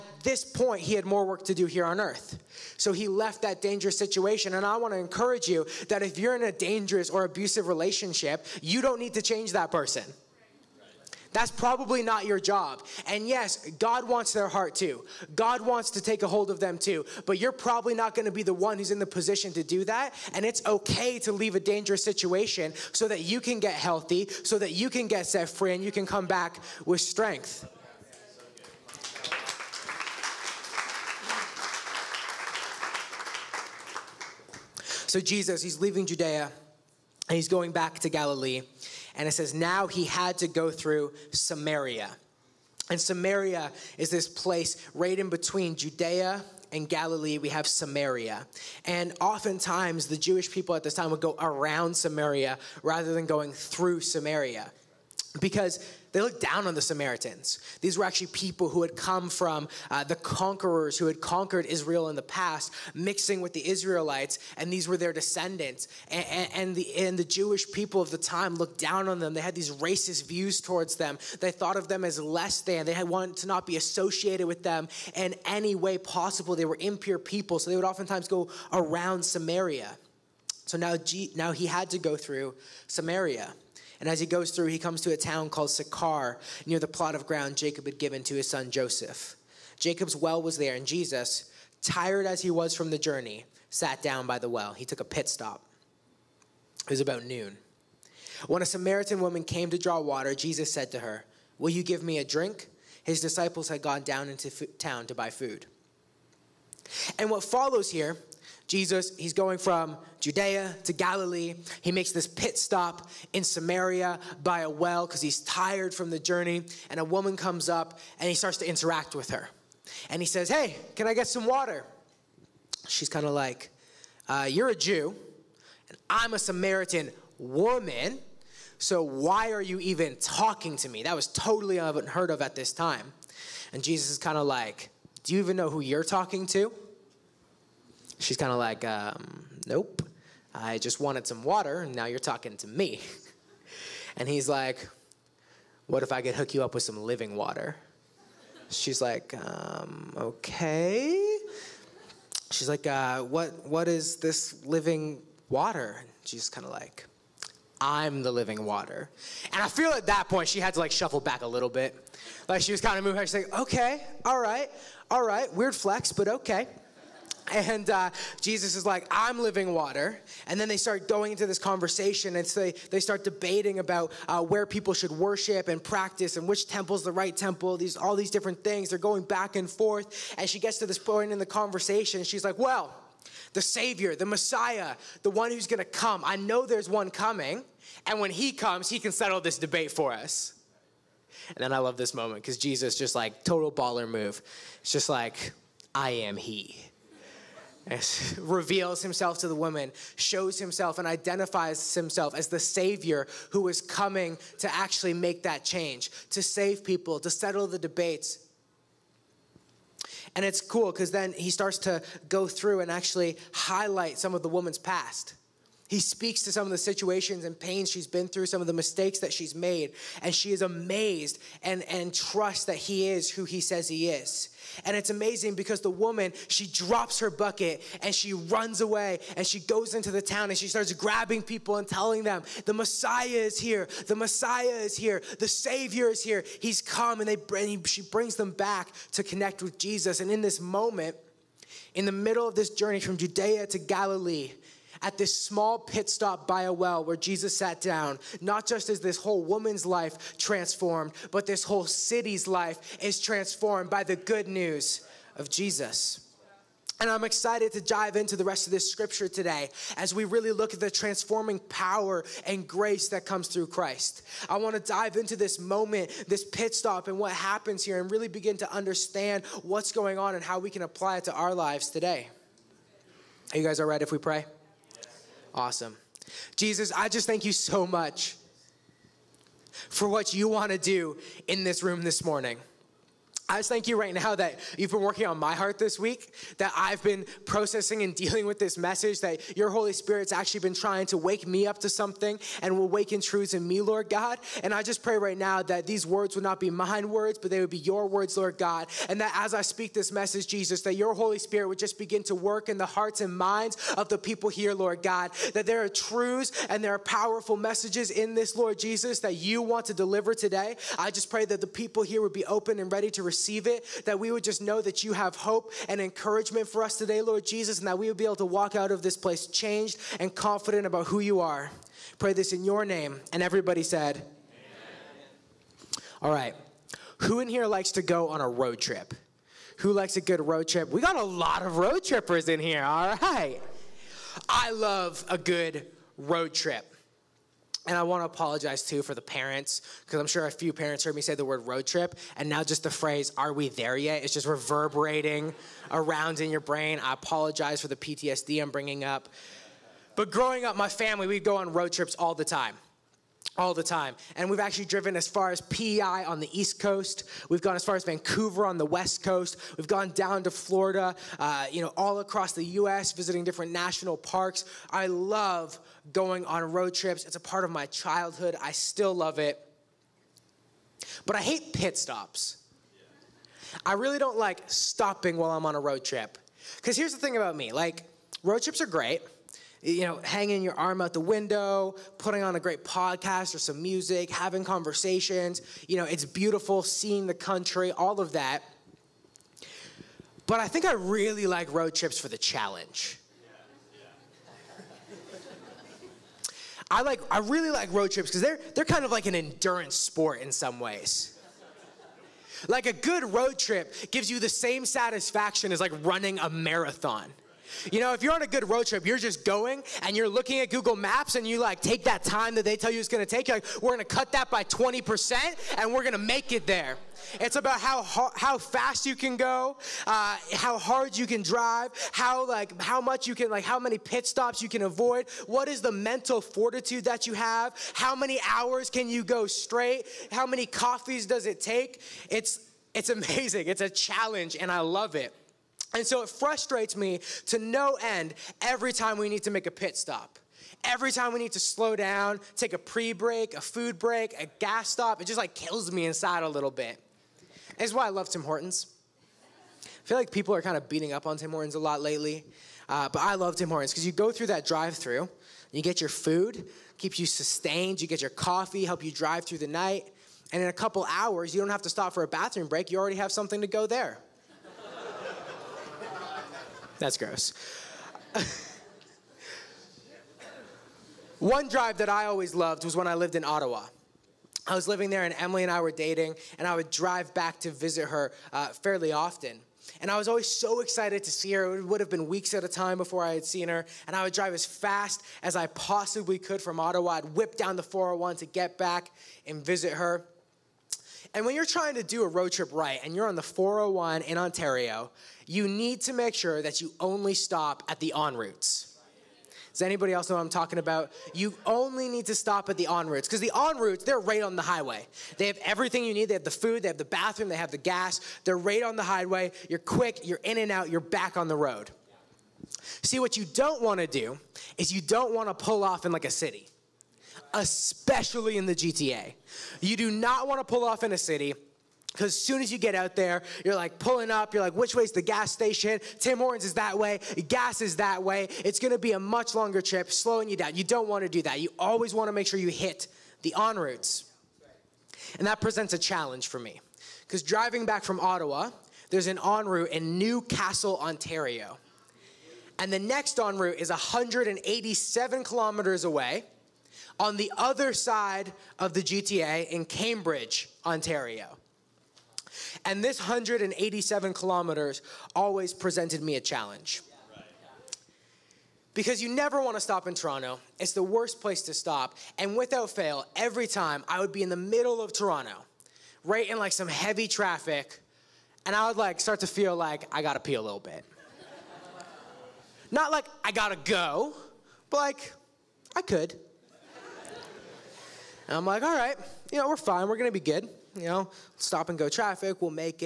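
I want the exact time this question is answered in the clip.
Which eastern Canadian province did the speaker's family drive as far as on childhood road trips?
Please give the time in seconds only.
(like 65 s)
355 s.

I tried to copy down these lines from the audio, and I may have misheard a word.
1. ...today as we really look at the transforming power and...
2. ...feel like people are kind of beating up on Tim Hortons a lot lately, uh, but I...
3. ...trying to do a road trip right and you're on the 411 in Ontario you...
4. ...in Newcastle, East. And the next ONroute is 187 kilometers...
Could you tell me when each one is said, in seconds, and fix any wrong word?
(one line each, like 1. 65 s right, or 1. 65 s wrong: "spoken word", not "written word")
1. 259 s right
2. 450 s right
3. 491 s wrong: "401", not "411"
4. 539 s wrong: "Ontario", not "East".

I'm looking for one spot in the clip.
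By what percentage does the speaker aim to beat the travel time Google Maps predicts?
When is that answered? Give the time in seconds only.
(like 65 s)
414 s.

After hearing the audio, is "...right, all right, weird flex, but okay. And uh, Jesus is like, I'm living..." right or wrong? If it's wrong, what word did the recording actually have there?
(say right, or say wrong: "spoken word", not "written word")
right.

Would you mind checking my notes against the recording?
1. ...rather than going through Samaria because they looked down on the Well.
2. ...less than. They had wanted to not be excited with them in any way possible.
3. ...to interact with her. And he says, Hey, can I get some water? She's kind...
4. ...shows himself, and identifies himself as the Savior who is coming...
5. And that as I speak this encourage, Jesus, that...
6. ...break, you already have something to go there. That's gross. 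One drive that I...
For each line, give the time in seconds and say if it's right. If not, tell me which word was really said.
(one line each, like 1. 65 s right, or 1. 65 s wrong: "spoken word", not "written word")
1. 52 s wrong: "Samaritans", not "Well"
2. 72 s wrong: "associated", not "excited"
3. 118 s right
4. 200 s right
5. 299 s wrong: "message", not "encourage"
6. 462 s right.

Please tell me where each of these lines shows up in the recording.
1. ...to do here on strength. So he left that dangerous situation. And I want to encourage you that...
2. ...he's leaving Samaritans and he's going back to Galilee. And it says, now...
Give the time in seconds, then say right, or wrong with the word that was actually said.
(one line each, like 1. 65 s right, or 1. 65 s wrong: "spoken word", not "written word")
1. 1 s wrong: "earth", not "strength"
2. 35 s wrong: "Judea", not "Samaritans".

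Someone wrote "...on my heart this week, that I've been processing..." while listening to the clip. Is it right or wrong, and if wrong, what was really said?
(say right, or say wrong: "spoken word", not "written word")
right.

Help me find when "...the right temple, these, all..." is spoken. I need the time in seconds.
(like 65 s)
177 s.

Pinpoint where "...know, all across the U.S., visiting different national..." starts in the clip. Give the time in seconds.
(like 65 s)
361 s.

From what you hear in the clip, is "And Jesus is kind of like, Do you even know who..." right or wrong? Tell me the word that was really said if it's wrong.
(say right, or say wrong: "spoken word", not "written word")
right.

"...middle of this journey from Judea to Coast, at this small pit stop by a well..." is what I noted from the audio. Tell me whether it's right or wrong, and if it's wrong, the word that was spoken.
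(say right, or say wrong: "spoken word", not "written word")
wrong: "Galilee", not "Coast".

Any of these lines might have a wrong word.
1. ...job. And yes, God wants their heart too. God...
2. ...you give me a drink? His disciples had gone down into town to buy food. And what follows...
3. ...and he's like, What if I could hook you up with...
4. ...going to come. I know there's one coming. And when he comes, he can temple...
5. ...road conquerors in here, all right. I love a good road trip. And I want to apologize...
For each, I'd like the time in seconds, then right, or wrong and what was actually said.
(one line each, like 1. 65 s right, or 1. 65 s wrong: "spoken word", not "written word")
1. 12 s right
2. 101 s right
3. 144 s right
4. 185 s wrong: "settle", not "temple"
5. 331 s wrong: "trippers", not "conquerors".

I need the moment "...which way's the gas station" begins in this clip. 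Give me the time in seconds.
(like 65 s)
524 s.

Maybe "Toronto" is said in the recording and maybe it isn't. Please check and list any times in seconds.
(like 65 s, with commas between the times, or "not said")
560 s, 565 s.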